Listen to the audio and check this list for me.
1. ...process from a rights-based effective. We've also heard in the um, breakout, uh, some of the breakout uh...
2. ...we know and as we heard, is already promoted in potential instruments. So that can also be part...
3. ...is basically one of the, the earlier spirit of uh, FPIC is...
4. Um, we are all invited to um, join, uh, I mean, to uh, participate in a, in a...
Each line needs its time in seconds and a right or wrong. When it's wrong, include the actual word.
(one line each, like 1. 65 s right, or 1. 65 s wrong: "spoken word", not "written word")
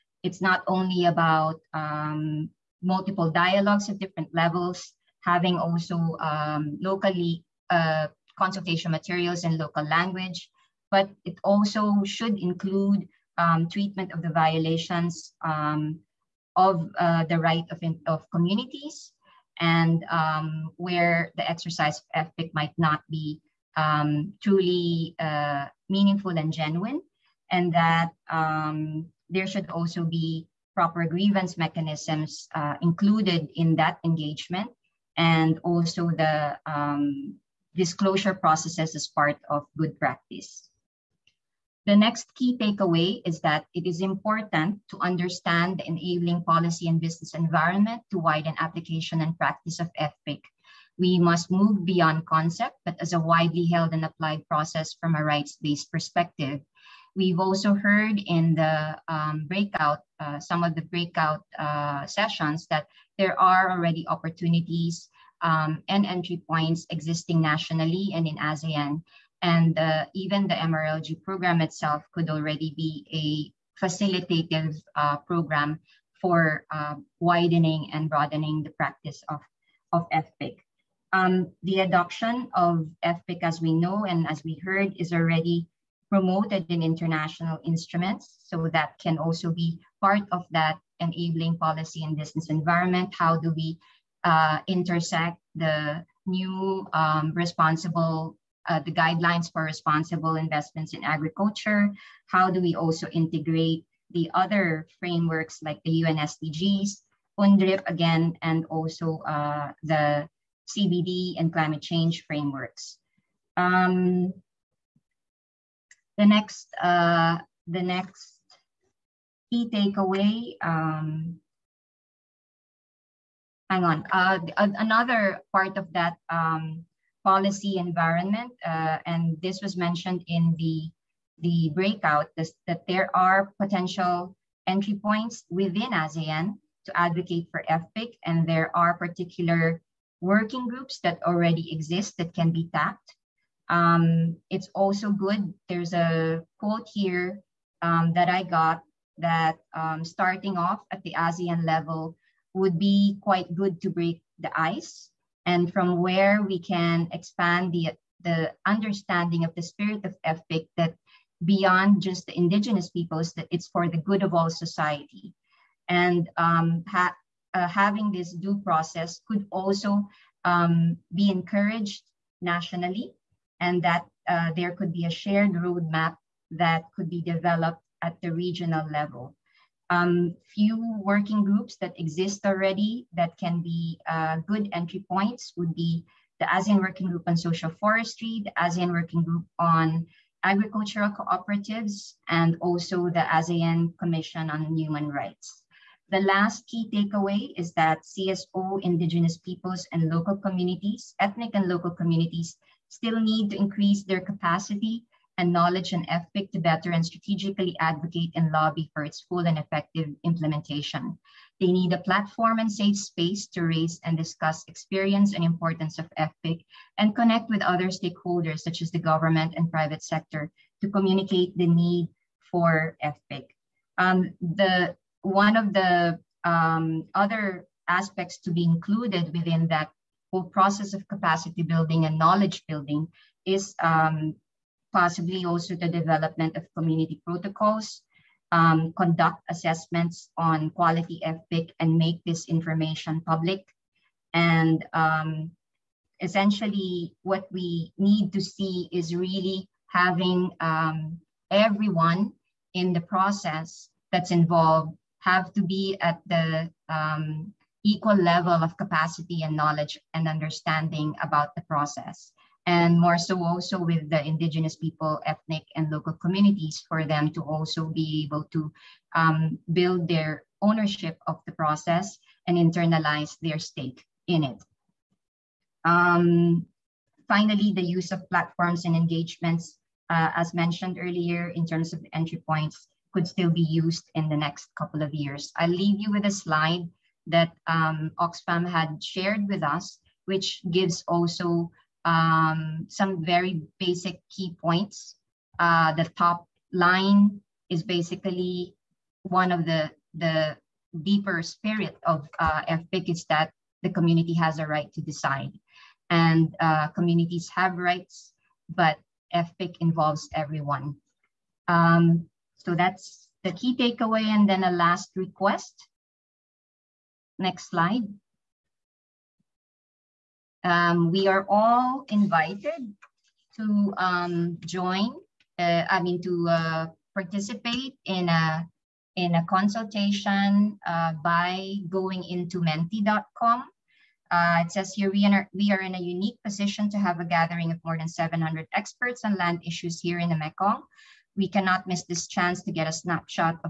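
1. 54 s wrong: "perspective", not "effective"
2. 83 s wrong: "international", not "potential"
3. 297 s wrong: "deeper", not "earlier"
4. 320 s right.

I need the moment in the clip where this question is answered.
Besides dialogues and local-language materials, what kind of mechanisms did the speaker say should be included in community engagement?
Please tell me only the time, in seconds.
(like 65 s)
31 s.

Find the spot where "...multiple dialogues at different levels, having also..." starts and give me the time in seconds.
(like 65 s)
2 s.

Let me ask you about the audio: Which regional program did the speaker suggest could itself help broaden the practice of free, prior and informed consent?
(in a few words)
MRLG program.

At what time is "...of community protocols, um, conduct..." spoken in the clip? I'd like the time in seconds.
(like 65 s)
236 s.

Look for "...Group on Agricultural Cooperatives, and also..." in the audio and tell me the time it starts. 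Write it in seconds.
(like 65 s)
189 s.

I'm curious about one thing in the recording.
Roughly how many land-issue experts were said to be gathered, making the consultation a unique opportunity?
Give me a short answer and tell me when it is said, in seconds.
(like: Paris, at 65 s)
700, at 338 s.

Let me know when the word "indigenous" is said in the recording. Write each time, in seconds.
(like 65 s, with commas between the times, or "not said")
162 s, 198 s, 264 s.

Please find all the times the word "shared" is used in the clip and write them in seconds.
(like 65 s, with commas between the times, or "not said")
175 s, 289 s.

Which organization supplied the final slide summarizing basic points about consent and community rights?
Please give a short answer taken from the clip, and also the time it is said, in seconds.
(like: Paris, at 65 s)
Oxfam, at 288 s.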